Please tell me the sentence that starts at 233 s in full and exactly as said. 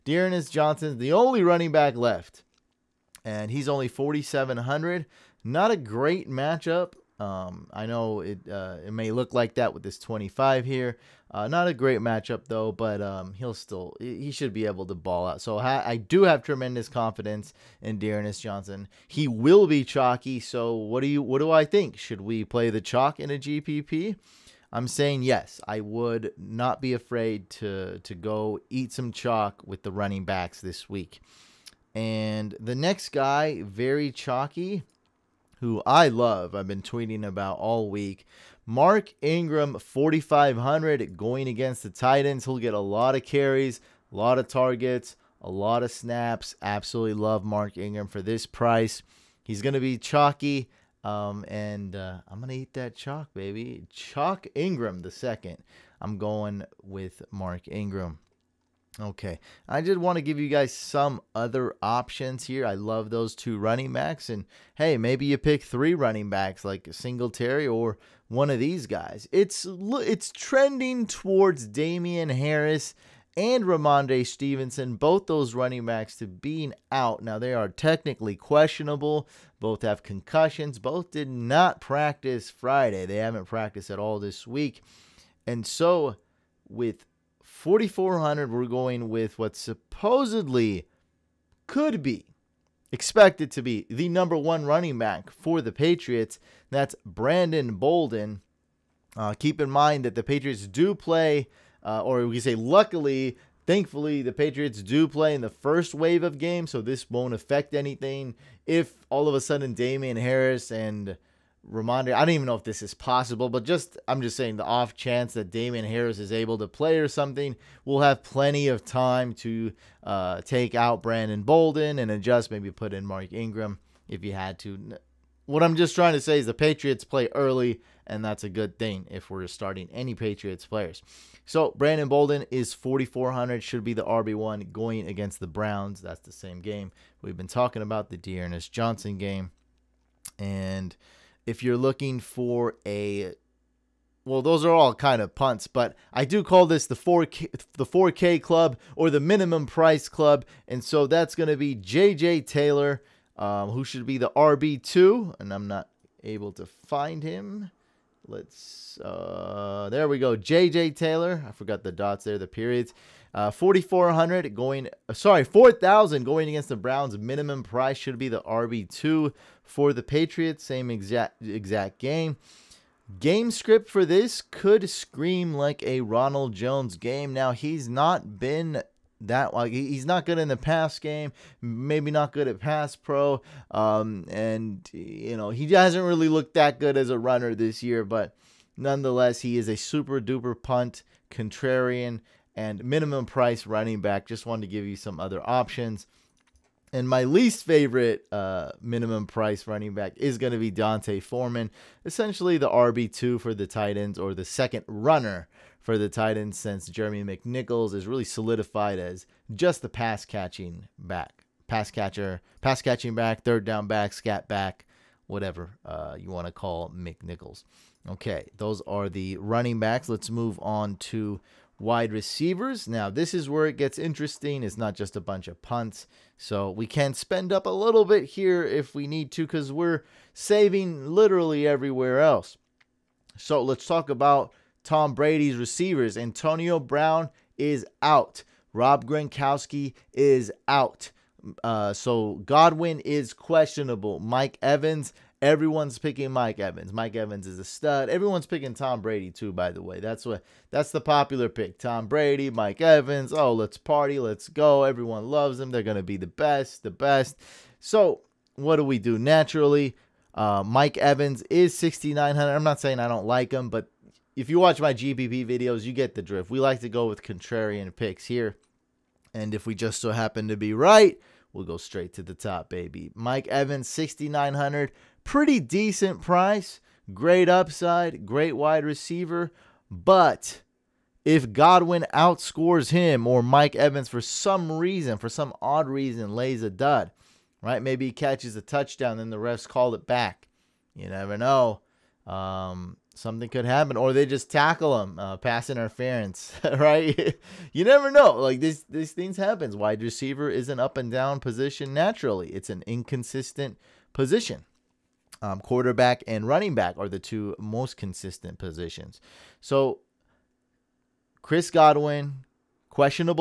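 So let's talk about Tom Brady's receivers.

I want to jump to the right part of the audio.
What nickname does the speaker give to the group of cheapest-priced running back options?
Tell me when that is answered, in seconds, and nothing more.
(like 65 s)
147 s.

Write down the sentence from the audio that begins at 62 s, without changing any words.
I love those two running backs.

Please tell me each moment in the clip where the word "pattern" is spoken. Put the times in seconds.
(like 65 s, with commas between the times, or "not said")
not said.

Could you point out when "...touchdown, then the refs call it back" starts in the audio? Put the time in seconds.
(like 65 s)
288 s.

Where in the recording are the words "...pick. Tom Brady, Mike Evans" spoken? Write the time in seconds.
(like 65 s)
251 s.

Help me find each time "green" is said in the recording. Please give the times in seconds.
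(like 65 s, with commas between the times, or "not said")
not said.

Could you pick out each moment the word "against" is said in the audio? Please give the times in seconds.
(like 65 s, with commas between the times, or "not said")
41 s, 135 s, 166 s.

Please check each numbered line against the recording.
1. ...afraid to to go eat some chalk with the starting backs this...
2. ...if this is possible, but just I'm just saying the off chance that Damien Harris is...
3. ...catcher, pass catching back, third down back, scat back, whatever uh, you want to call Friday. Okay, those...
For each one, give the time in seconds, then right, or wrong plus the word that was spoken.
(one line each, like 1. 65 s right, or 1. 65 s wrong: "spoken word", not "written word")
1. 26 s wrong: "running", not "starting"
2. 112 s right
3. 211 s wrong: "McNichols", not "Friday".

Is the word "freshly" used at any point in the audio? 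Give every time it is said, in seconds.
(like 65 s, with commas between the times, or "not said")
not said.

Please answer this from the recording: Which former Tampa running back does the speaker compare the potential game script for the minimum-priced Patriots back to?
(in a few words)
Ronald Jones.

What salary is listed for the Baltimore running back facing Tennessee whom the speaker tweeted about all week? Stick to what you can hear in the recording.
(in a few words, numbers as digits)
4,500.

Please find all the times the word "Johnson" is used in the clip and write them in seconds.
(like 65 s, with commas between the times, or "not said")
0 s, 18 s, 138 s.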